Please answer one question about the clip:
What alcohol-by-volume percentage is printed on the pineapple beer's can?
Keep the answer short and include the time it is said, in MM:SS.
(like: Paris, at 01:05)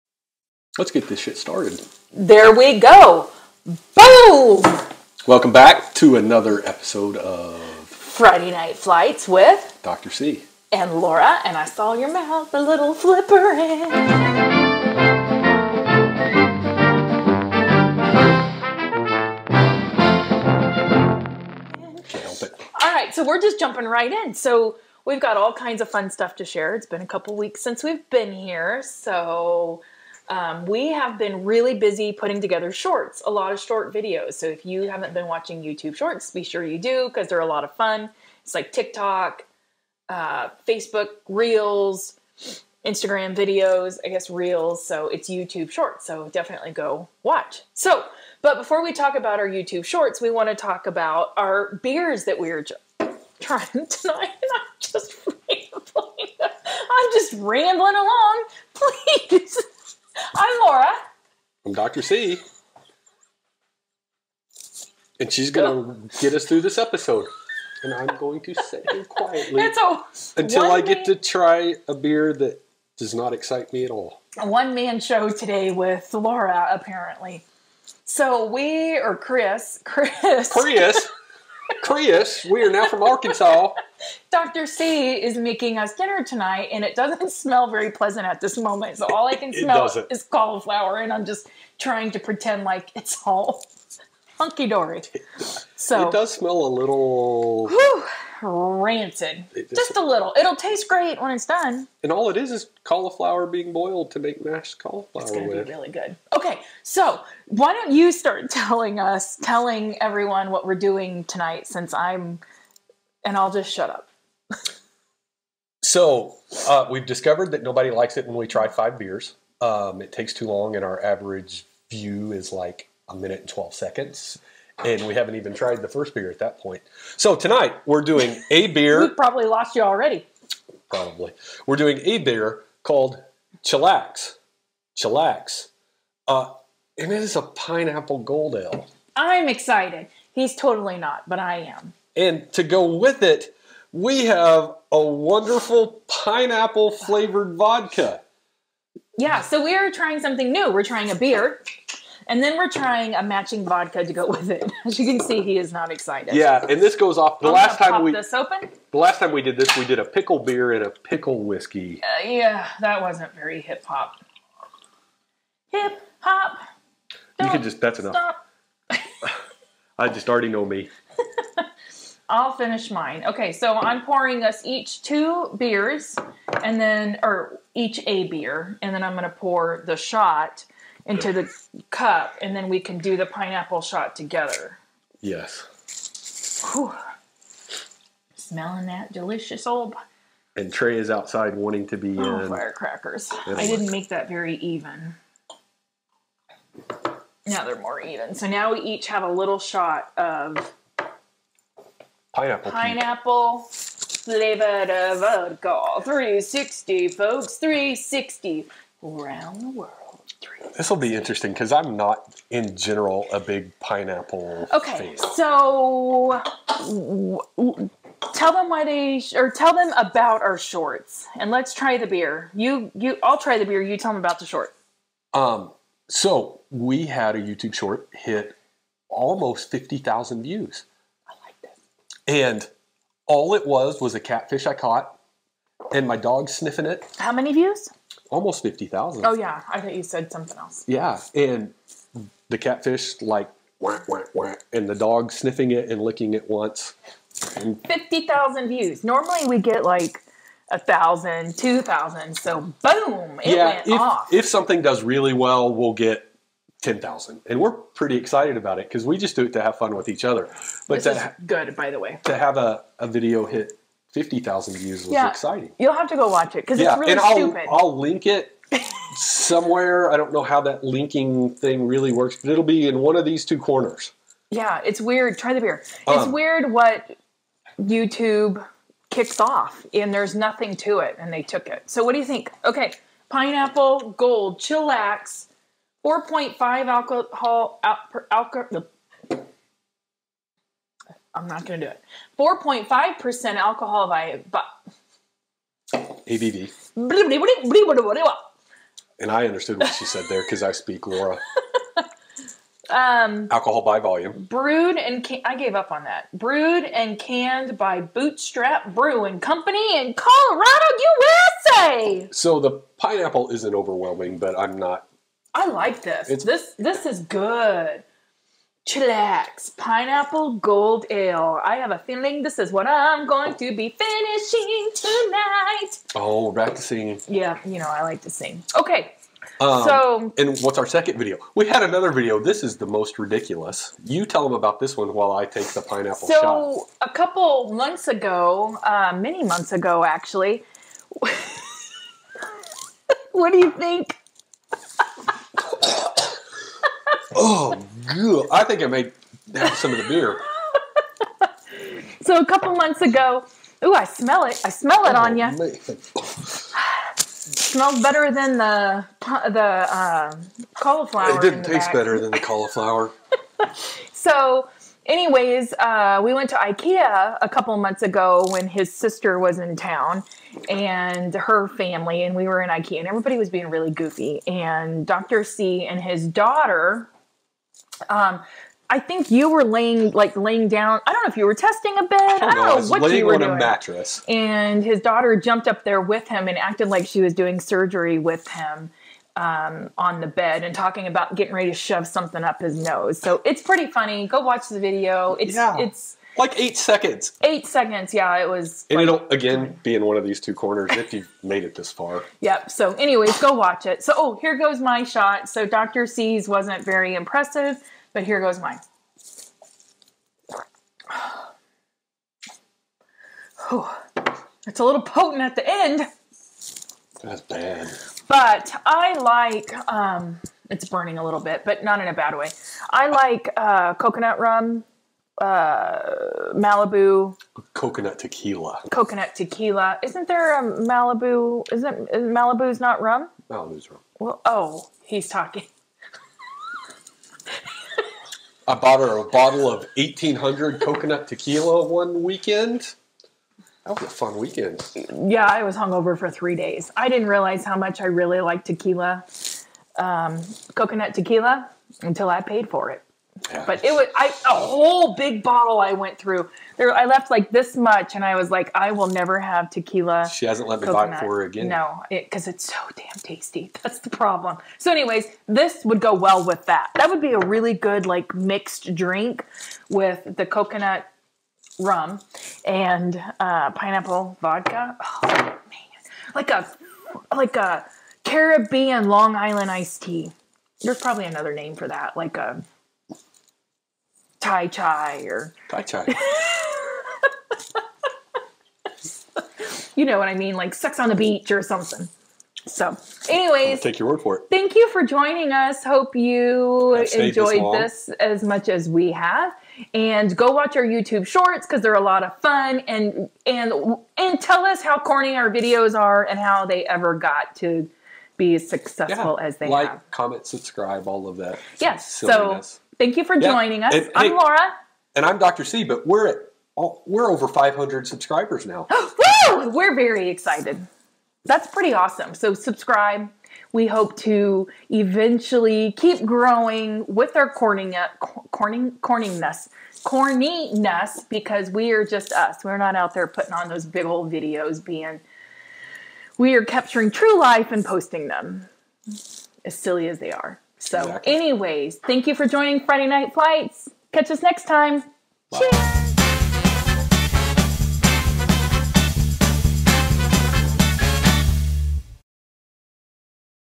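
4.5%, at 04:52.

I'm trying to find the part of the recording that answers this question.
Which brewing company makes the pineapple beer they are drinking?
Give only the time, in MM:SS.
05:08.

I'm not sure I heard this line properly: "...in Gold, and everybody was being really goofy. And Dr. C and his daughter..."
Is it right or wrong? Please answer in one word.
wrong.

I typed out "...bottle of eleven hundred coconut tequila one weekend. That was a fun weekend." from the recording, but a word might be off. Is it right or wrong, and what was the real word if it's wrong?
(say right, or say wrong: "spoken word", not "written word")
wrong: "eighteen", not "eleven".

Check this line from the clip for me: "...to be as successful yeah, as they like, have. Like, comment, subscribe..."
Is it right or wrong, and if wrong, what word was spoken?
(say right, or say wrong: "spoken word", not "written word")
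right.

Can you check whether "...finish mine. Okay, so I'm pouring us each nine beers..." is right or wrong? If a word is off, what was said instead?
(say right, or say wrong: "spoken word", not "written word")
wrong: "two", not "nine".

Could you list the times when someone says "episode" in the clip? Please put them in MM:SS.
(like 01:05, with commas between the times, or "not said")
00:06, 01:06.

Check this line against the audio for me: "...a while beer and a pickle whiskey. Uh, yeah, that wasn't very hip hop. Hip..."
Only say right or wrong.
wrong.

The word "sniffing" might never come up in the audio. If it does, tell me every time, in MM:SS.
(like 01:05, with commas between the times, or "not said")
03:56, 04:05.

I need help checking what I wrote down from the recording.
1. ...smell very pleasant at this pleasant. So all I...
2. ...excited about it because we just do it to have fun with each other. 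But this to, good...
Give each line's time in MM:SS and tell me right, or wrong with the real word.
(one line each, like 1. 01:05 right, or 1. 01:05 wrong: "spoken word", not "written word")
1. 01:27 wrong: "moment", not "pleasant"
2. 04:18 right.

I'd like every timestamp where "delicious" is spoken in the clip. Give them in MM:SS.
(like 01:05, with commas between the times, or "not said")
03:09.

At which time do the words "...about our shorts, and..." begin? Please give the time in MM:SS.
03:39.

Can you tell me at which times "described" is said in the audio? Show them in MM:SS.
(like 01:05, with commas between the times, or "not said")
not said.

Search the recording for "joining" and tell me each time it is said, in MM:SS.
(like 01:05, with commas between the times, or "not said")
08:15, 08:33, 09:02.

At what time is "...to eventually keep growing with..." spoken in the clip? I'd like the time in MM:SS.
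08:44.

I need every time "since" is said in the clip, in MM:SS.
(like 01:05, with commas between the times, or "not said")
00:27, 01:51.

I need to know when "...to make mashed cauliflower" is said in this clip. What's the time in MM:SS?
01:44.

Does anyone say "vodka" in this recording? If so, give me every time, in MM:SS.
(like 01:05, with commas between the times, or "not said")
02:27, 02:33, 03:25, 07:54.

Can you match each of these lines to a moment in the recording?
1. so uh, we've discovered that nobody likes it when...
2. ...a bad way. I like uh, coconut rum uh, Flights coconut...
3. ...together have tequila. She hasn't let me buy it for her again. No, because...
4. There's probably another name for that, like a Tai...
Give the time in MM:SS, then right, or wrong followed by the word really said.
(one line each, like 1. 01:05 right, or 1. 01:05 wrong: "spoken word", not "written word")
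1. 01:55 right
2. 07:02 wrong: "Malibu", not "Flights"
3. 07:39 wrong: "never", not "together"
4. 08:00 right.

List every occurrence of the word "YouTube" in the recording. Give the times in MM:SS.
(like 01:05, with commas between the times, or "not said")
00:35, 00:45, 00:49, 03:47, 04:37, 08:20.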